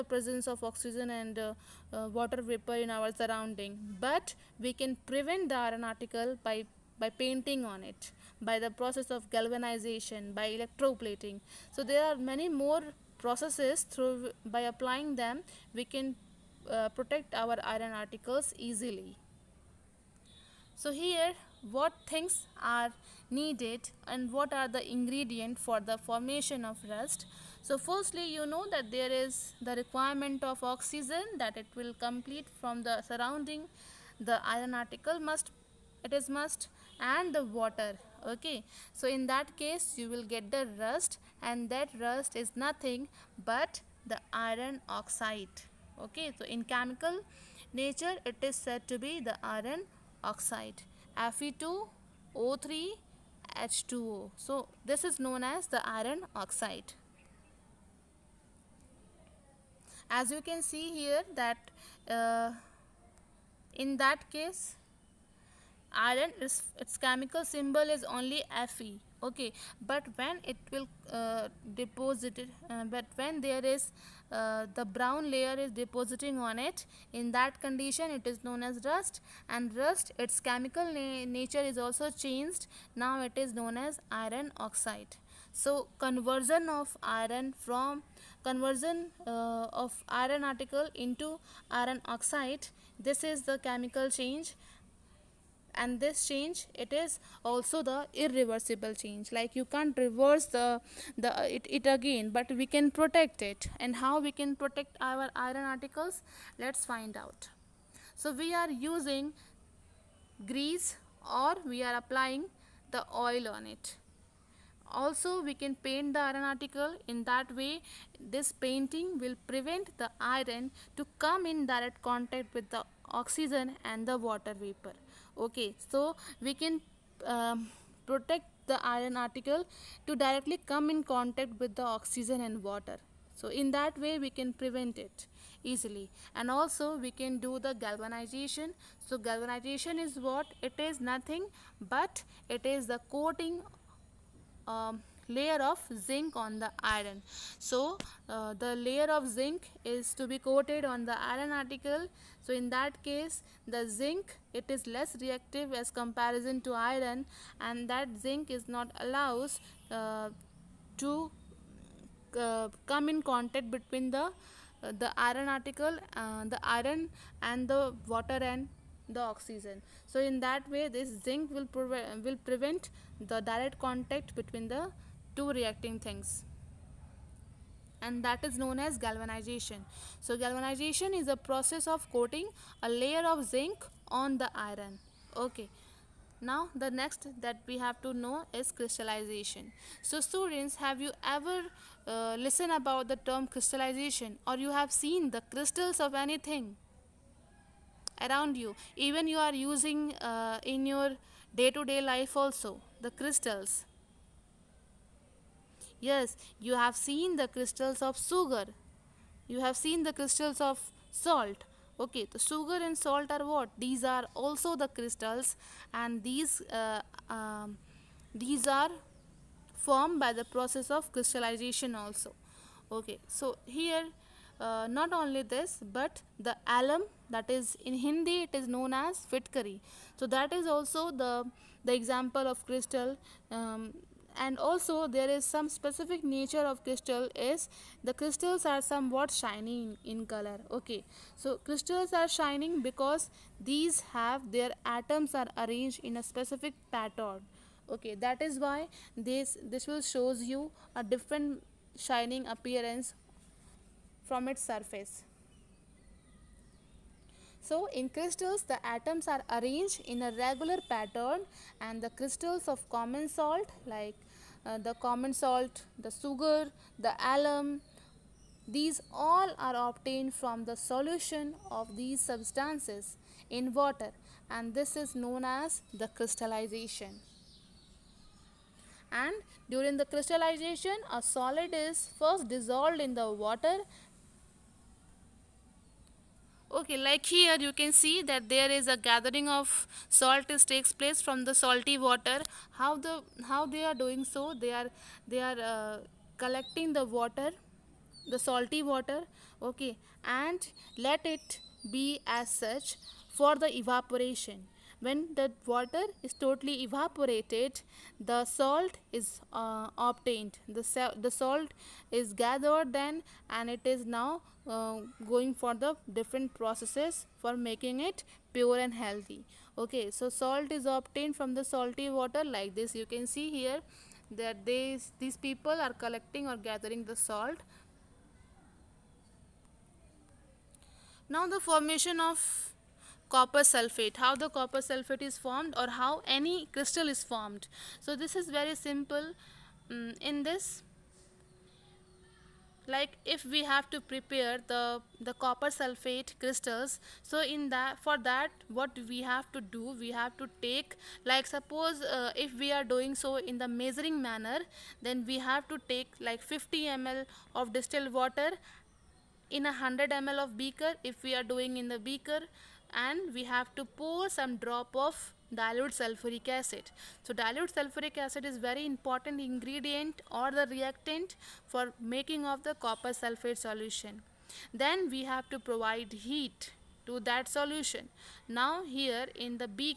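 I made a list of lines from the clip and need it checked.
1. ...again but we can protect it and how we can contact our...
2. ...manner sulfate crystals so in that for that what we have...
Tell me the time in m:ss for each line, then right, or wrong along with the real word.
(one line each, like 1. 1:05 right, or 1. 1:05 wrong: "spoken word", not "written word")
1. 1:41 wrong: "protect", not "contact"
2. 5:45 wrong: "copper", not "manner".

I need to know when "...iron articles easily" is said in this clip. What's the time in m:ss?
0:17.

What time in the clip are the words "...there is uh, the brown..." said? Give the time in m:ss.
1:13.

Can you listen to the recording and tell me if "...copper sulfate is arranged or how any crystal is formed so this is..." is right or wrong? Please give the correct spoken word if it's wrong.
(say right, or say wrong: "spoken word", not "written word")
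wrong: "formed", not "arranged".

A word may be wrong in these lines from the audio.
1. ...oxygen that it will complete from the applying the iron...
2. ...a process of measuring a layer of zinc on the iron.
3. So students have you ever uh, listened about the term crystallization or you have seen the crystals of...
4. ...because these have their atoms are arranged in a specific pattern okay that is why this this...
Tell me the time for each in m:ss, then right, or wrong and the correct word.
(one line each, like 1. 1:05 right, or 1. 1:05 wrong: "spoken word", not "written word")
1. 0:30 wrong: "surrounding", not "applying"
2. 3:01 wrong: "coating", not "measuring"
3. 3:10 right
4. 4:02 right.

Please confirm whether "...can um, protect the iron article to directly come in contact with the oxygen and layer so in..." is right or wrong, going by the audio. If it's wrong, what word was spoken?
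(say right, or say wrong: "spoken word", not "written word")
wrong: "water", not "layer".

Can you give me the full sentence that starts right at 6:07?
So dilute sulfuric acid is very important ingredient or the reactant for making of the copper sulfate solution.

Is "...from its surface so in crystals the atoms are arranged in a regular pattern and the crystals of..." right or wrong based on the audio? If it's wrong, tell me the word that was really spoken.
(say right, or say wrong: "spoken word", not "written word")
right.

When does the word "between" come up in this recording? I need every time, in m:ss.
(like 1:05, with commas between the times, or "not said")
2:43, 2:54.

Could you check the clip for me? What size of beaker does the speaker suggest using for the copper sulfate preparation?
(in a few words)
100 ml.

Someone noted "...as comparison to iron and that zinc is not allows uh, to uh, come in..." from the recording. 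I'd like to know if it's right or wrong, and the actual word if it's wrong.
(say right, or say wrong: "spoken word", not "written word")
right.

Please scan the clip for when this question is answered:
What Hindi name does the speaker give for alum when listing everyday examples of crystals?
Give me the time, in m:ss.
3:49.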